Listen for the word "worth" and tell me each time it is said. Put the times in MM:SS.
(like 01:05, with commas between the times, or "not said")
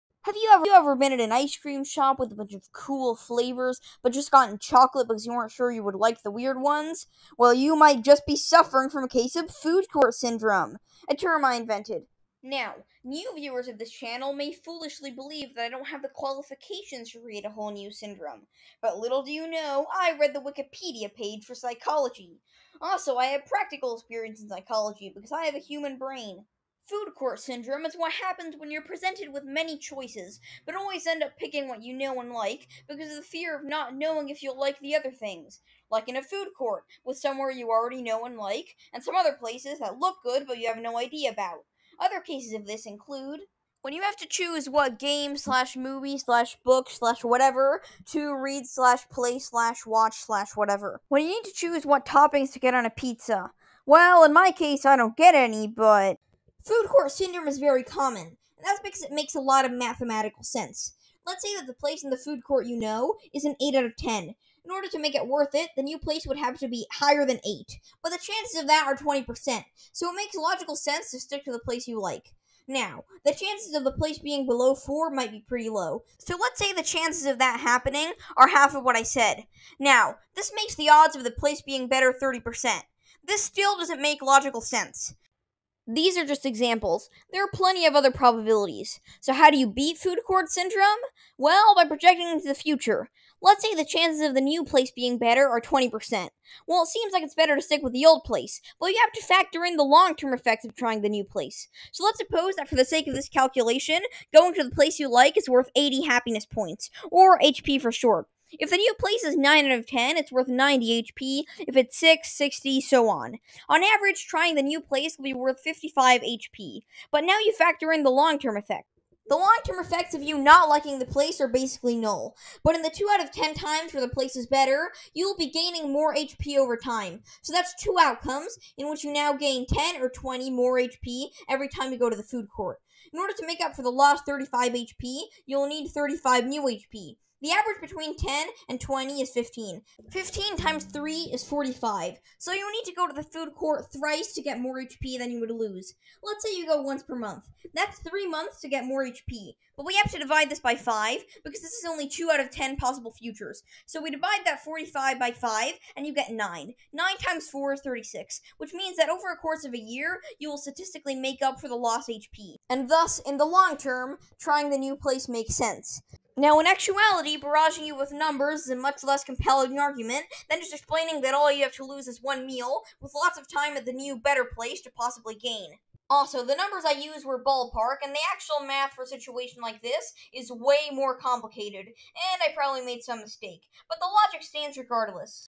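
01:05, 01:45, 01:50, 01:55.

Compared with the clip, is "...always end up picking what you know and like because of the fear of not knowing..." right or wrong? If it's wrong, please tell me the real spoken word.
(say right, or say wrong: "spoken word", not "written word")
right.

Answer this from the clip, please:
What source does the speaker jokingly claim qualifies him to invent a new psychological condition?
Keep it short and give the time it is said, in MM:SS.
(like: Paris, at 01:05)
Wikipedia page for psychology, at 00:20.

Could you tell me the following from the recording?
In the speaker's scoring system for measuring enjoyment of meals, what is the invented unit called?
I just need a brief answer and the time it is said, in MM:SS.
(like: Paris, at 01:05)
happiness points, at 01:46.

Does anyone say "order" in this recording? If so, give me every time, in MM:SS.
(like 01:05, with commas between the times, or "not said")
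01:04, 02:13.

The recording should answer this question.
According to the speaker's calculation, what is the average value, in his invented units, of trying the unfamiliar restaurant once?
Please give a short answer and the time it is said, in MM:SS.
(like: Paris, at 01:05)
55 HP, at 01:55.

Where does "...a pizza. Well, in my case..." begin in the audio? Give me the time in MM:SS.
00:52.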